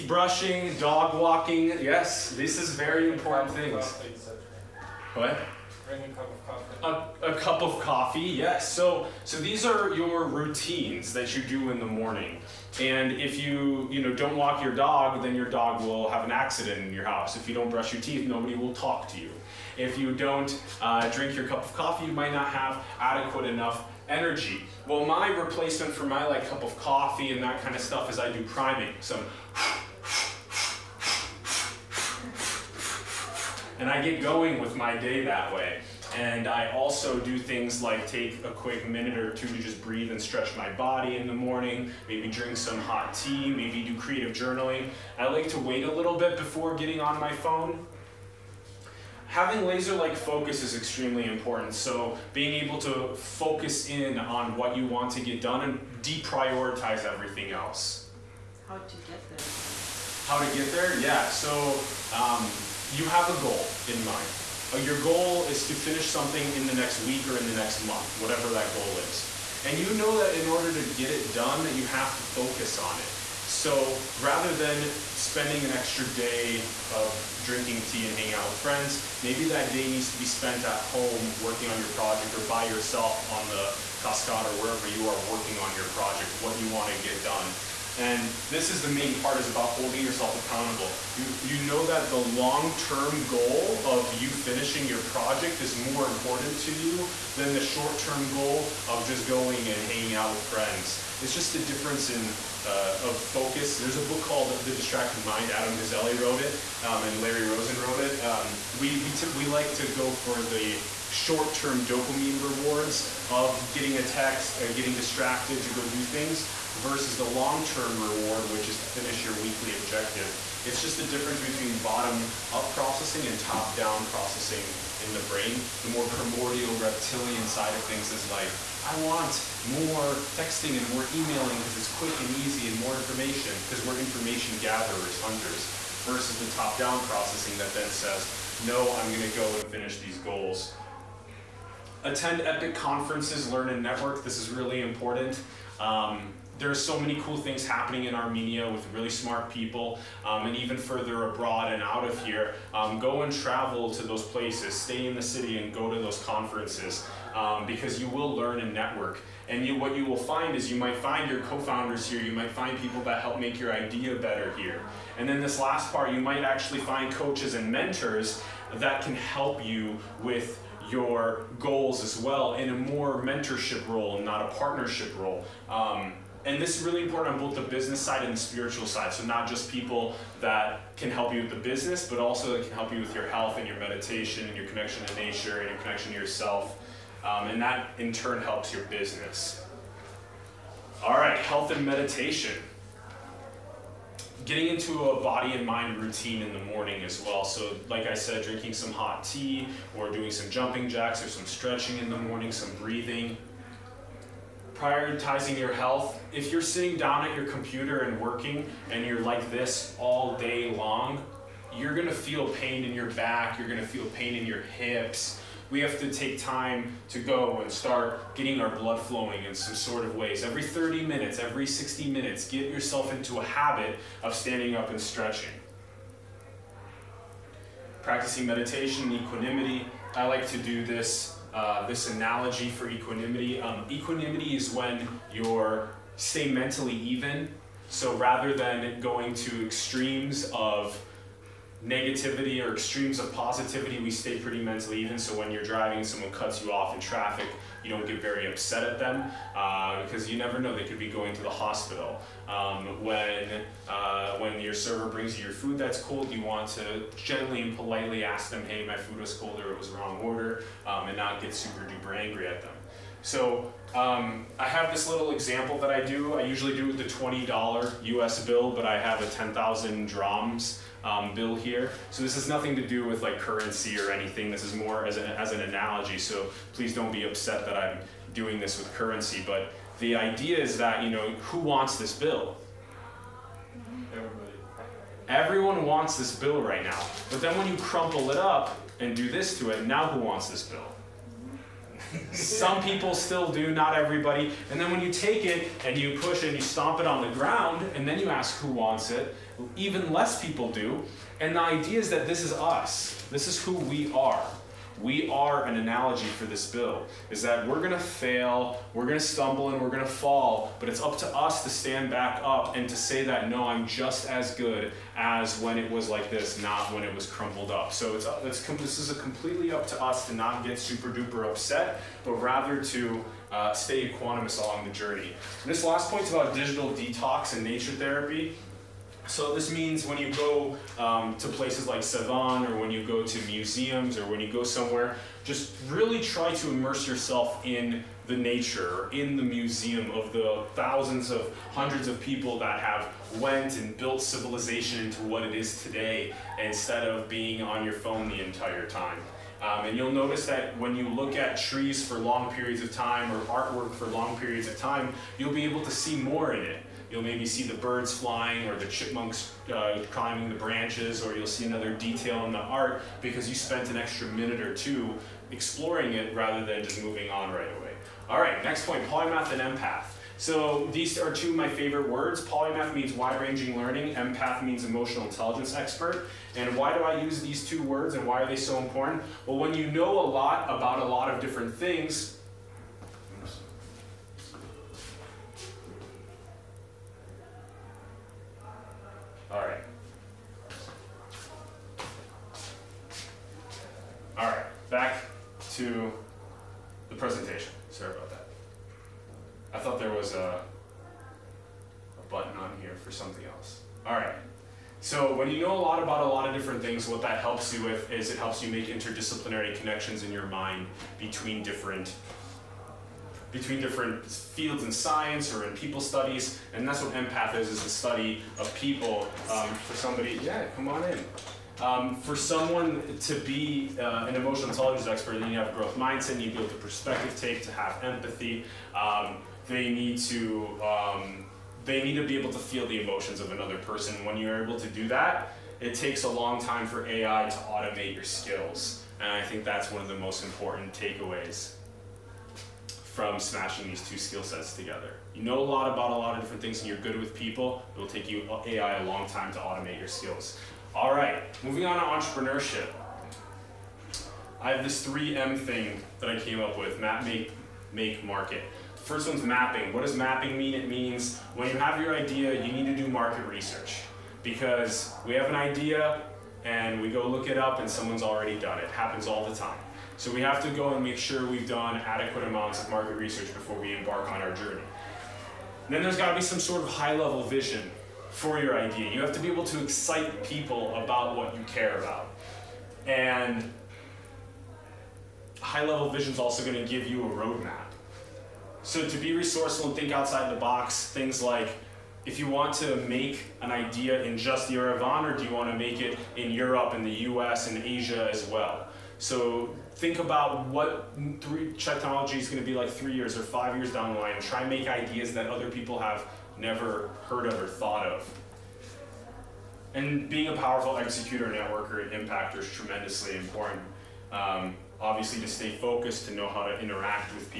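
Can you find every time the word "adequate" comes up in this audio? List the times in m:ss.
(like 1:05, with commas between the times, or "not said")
0:22, 7:51.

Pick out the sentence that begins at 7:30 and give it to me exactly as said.
All right, moving on to entrepreneurship.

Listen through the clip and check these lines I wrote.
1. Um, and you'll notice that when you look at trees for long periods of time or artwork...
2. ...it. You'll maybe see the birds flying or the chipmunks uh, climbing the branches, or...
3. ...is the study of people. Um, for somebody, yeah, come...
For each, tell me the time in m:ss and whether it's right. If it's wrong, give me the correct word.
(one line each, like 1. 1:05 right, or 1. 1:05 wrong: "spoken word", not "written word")
1. 5:49 right
2. 5:56 right
3. 6:57 right.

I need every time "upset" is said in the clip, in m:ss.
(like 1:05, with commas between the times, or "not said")
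4:08, 4:37, 5:21.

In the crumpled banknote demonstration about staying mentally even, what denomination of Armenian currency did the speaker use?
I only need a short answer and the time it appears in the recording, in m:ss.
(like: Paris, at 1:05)
10,000 drams, at 4:29.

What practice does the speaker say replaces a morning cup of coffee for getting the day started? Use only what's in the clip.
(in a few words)
Priming.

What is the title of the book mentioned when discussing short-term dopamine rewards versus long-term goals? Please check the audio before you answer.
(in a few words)
The Distracted Mind.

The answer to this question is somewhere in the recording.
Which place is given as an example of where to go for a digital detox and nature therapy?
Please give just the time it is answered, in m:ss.
5:32.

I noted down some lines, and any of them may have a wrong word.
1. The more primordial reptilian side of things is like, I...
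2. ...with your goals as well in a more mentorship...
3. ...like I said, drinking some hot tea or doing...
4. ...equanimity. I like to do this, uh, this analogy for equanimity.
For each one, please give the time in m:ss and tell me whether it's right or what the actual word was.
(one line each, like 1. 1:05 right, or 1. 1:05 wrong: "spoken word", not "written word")
1. 2:05 right
2. 2:50 right
3. 3:17 right
4. 3:49 right.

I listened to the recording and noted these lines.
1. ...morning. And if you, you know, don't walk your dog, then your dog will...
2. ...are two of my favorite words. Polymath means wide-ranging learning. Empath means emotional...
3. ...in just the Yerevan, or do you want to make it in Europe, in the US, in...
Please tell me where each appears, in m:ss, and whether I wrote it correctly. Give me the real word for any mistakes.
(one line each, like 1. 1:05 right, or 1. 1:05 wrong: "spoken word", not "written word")
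1. 0:11 right
2. 6:11 right
3. 8:14 right.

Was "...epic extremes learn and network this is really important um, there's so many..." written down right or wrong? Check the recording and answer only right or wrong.
wrong.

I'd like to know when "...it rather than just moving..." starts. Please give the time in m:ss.
6:06.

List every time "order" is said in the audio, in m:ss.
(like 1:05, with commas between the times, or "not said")
1:10, 4:20.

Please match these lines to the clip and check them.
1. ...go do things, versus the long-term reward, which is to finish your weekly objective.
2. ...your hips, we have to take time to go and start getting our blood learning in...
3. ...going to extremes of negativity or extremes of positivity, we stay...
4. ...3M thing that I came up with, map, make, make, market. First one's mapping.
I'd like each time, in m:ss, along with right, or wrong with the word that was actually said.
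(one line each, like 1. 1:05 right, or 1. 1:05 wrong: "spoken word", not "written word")
1. 1:55 right
2. 3:34 wrong: "flowing", not "learning"
3. 3:59 right
4. 7:35 right.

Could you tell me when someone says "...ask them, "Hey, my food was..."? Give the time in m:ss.
4:18.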